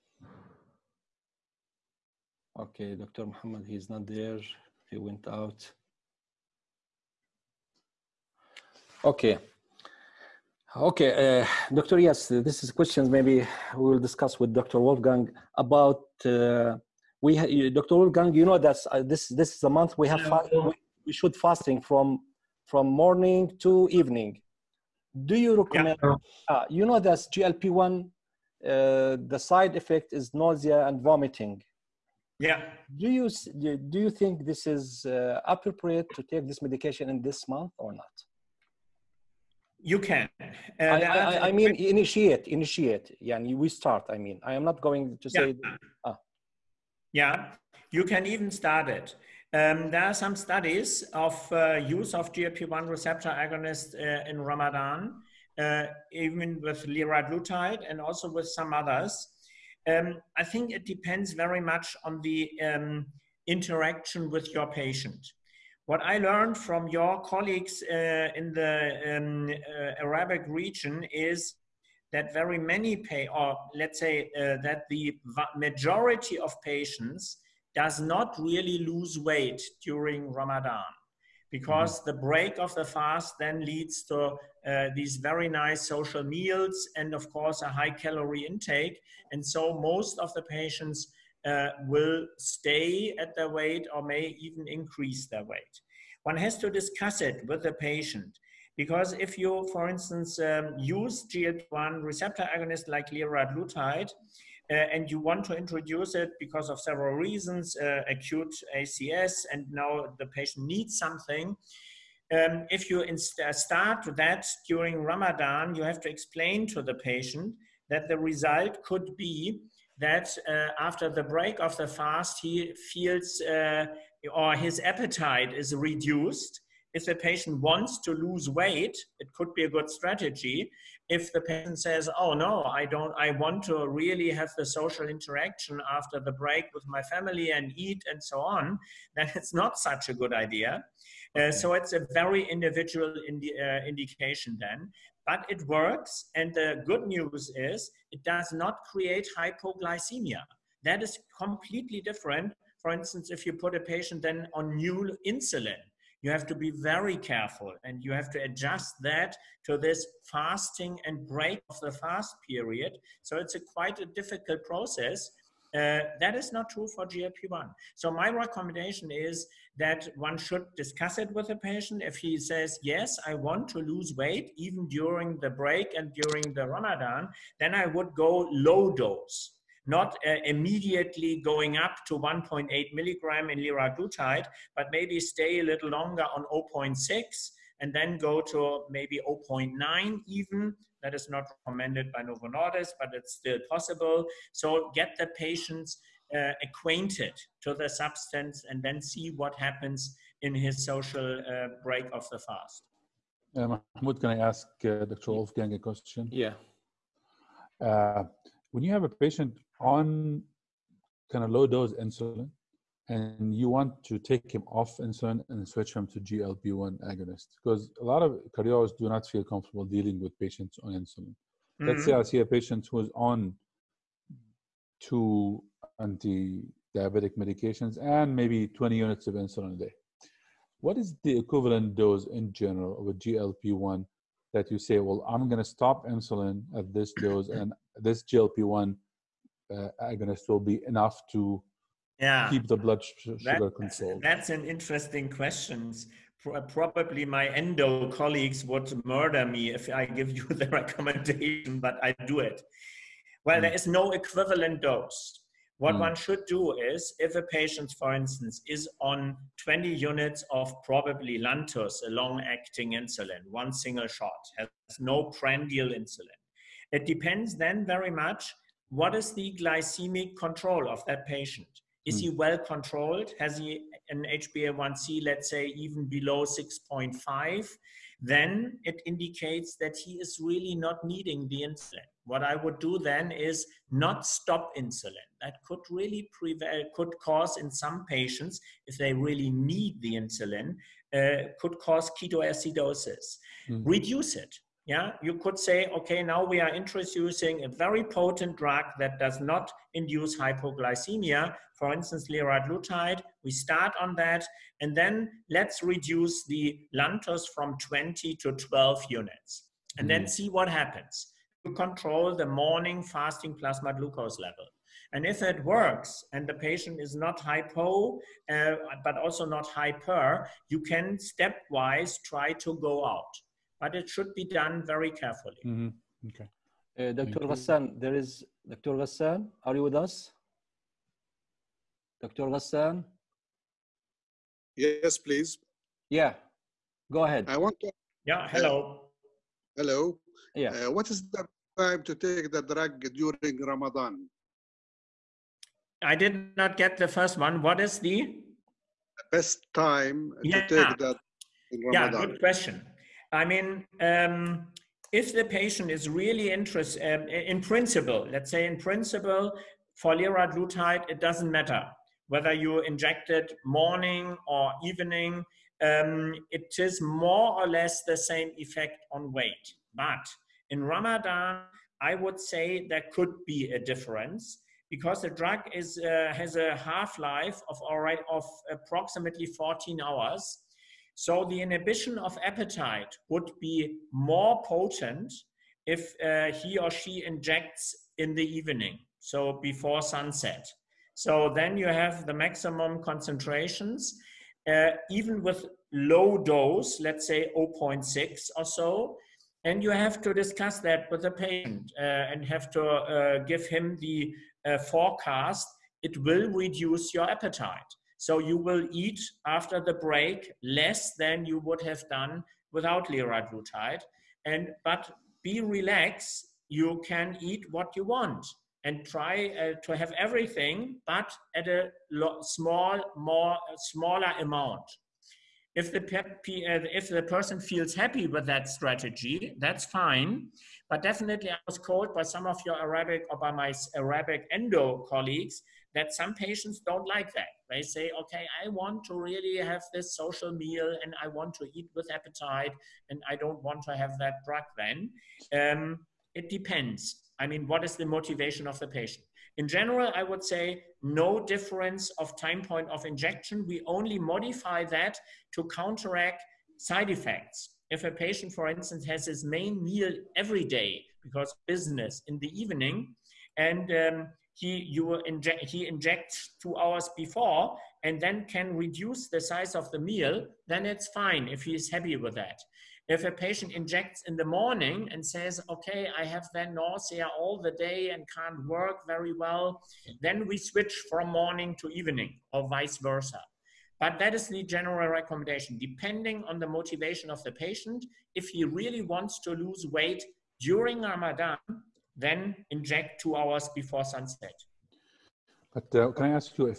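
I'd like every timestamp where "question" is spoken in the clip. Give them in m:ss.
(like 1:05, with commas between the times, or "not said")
0:12, 3:25, 4:05, 5:52.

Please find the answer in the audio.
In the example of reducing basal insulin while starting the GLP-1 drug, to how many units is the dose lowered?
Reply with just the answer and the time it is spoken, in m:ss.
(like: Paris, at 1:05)
12, at 5:08.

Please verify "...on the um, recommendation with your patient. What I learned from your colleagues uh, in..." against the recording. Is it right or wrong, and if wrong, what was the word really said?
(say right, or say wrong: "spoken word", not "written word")
wrong: "interaction", not "recommendation".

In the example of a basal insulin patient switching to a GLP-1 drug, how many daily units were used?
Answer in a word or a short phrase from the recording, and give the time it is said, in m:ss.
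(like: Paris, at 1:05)
20, at 3:48.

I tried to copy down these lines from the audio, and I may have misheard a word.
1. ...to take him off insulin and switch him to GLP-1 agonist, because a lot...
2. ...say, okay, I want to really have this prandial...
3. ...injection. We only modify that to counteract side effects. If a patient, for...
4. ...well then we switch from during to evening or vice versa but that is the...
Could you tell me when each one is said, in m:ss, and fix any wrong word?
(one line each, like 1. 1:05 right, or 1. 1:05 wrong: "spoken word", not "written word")
1. 3:34 right
2. 7:17 wrong: "social", not "prandial"
3. 7:33 right
4. 7:59 wrong: "morning", not "during".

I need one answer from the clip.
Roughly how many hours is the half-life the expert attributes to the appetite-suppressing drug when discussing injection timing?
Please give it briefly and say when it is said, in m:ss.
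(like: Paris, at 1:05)
14, at 6:19.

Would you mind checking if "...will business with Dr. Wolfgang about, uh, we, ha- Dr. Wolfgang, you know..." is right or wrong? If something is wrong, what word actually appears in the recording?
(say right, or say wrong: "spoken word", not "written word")
wrong: "discuss", not "business".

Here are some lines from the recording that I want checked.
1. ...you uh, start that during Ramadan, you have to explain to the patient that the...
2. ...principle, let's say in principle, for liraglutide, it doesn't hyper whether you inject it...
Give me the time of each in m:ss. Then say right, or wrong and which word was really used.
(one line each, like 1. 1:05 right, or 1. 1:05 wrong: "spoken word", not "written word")
1. 1:52 right
2. 5:57 wrong: "matter", not "hyper".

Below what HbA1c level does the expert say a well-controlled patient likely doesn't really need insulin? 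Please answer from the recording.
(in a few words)
6.5.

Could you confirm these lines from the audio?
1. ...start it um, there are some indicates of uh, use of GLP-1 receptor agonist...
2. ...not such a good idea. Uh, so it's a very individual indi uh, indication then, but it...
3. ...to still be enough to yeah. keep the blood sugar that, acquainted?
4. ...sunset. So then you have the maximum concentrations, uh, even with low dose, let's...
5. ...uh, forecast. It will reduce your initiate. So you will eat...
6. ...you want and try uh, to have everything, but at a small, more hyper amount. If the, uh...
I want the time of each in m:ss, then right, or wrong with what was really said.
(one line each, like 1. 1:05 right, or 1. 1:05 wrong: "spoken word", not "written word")
1. 0:48 wrong: "studies", not "indicates"
2. 2:19 right
3. 4:00 wrong: "controlled", not "acquainted"
4. 6:30 right
5. 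6:44 wrong: "appetite", not "initiate"
6. 6:57 wrong: "smaller", not "hyper".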